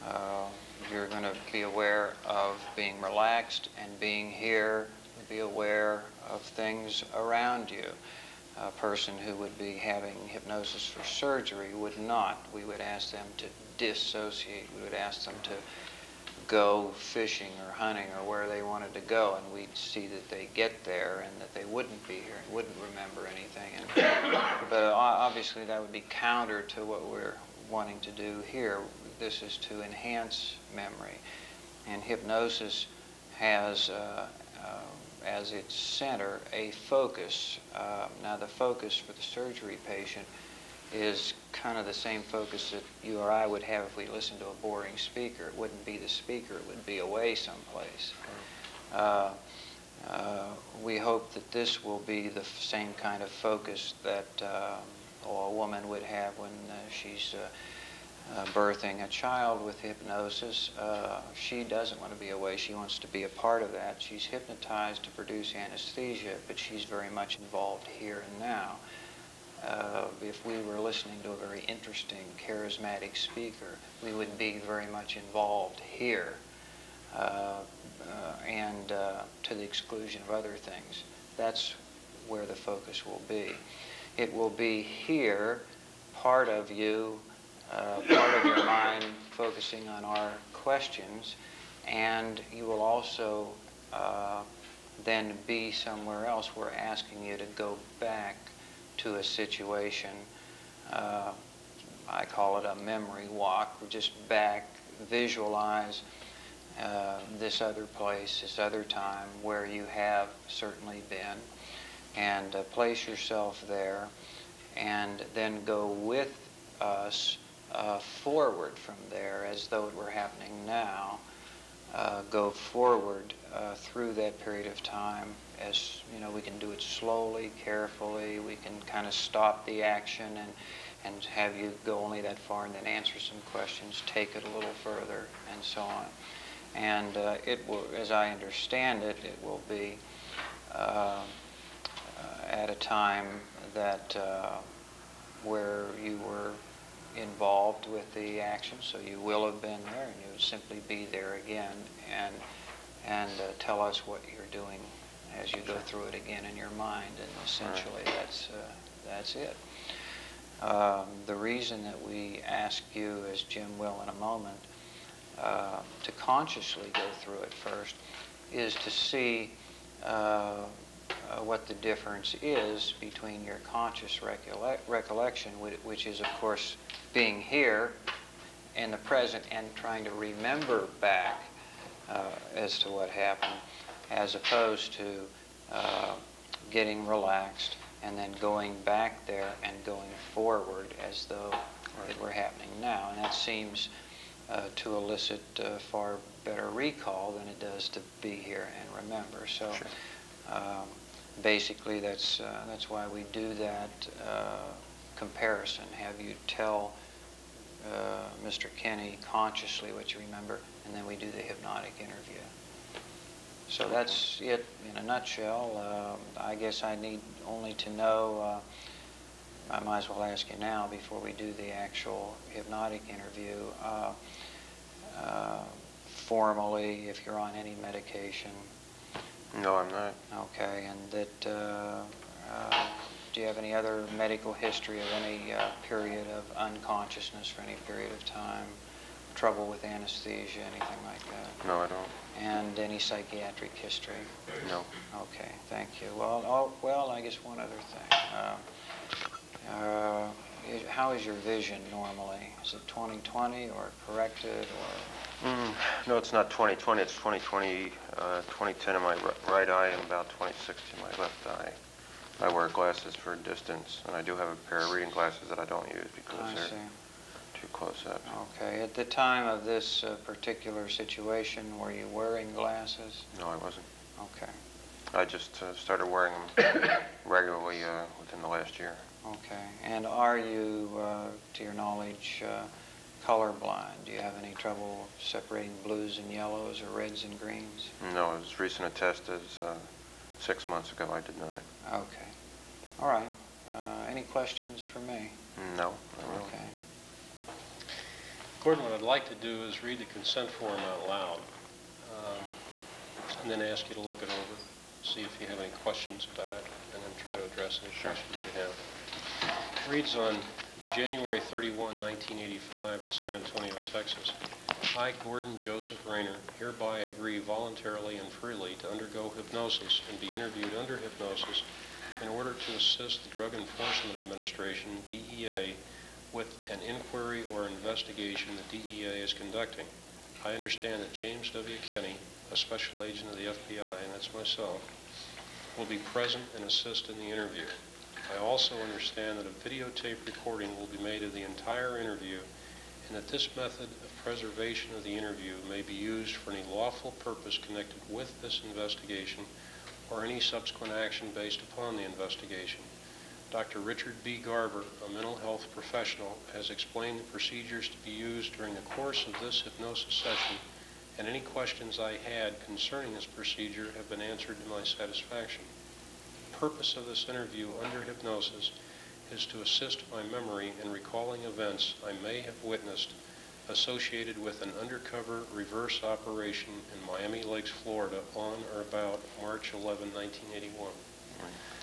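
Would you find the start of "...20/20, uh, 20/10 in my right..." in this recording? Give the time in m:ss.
4:17.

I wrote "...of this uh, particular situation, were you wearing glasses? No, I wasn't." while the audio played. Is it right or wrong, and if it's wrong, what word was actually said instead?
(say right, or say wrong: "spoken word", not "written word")
right.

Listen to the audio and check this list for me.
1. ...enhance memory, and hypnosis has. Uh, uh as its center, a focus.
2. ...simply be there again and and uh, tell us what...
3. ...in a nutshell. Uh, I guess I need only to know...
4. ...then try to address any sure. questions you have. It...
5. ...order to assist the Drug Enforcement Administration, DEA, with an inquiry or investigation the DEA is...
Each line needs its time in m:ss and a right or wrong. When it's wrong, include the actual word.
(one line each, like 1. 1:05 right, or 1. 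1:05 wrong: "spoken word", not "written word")
1. 0:29 right
2. 2:30 right
3. 3:34 right
4. 5:07 right
5. 5:22 right.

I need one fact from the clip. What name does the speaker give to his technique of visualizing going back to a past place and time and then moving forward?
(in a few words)
memory walk.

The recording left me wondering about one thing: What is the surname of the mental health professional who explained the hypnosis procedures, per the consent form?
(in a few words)
Garver.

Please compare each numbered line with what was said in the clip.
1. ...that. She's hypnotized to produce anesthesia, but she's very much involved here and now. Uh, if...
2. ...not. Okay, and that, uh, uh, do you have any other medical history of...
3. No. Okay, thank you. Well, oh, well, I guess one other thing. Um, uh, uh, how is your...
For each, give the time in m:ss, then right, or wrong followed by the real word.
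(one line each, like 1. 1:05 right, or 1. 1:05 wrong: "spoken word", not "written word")
1. 1:03 right
2. 3:49 right
3. 4:04 right.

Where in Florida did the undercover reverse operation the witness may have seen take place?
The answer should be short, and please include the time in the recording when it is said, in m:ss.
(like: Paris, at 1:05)
Miami Lakes, at 6:17.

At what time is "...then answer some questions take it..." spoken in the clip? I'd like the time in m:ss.
2:12.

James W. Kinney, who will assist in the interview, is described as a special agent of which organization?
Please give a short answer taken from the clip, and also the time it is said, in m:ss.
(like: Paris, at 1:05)
FBI, at 5:33.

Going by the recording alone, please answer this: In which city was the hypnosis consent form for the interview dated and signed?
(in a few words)
San Antonio.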